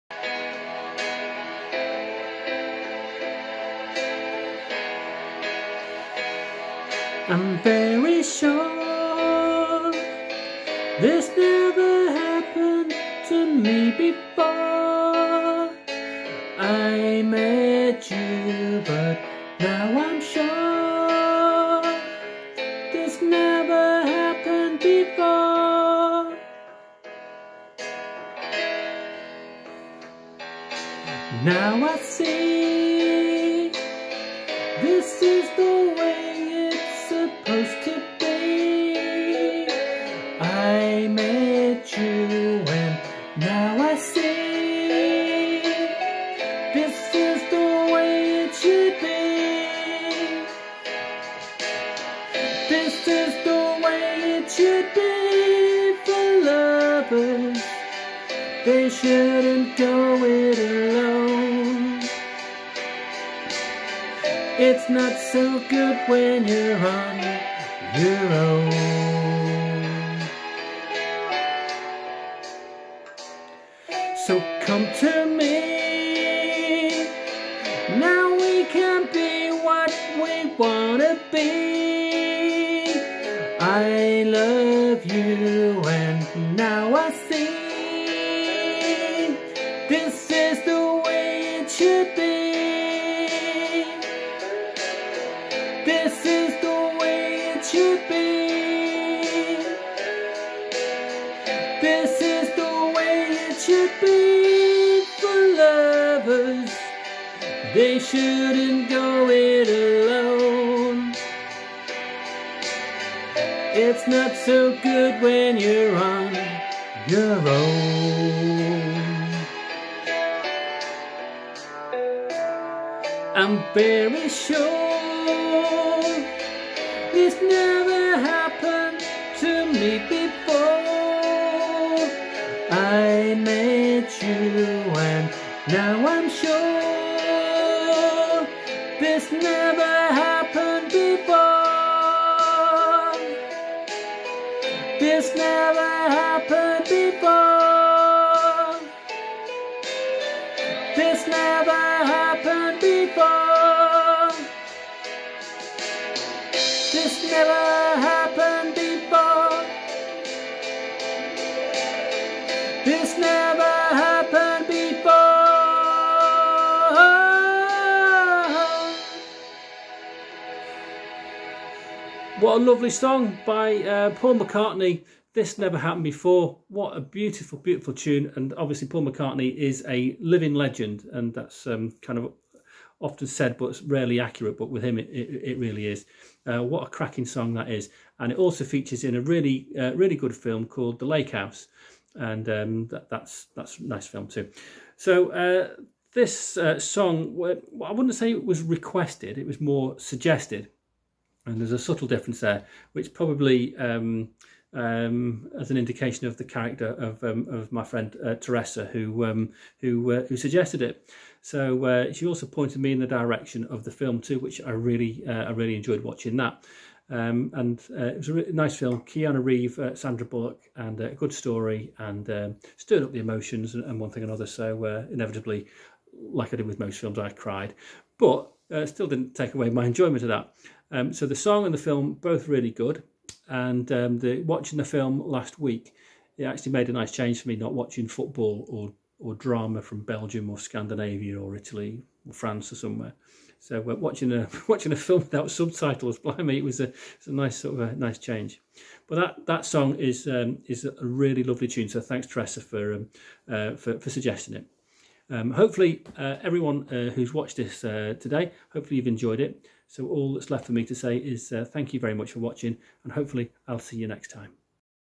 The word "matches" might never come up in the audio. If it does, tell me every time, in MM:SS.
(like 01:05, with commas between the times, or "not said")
not said.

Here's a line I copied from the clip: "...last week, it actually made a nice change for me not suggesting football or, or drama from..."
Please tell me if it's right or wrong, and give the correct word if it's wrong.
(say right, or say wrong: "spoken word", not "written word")
wrong: "watching", not "suggesting".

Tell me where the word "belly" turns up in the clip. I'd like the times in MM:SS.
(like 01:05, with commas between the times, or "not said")
not said.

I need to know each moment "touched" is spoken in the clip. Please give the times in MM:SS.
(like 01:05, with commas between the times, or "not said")
not said.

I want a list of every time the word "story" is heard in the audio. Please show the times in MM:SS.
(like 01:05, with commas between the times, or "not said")
03:41.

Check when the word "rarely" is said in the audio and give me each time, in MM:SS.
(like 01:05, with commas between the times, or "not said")
03:03.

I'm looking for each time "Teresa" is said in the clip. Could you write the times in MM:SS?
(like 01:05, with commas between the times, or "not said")
03:28, 04:12.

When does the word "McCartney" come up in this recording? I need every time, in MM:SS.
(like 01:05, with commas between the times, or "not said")
02:54, 02:59.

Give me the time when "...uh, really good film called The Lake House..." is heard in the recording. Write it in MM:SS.
03:09.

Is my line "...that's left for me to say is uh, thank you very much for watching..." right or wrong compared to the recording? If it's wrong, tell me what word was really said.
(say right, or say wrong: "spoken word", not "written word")
right.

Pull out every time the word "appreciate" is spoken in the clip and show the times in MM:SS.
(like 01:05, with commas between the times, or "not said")
not said.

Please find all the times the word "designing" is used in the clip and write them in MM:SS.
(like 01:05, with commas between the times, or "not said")
not said.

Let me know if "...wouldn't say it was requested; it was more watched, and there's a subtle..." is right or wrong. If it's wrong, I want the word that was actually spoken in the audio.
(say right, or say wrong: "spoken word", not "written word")
wrong: "suggested", not "watched".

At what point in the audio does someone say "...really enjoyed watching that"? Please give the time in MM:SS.
03:35.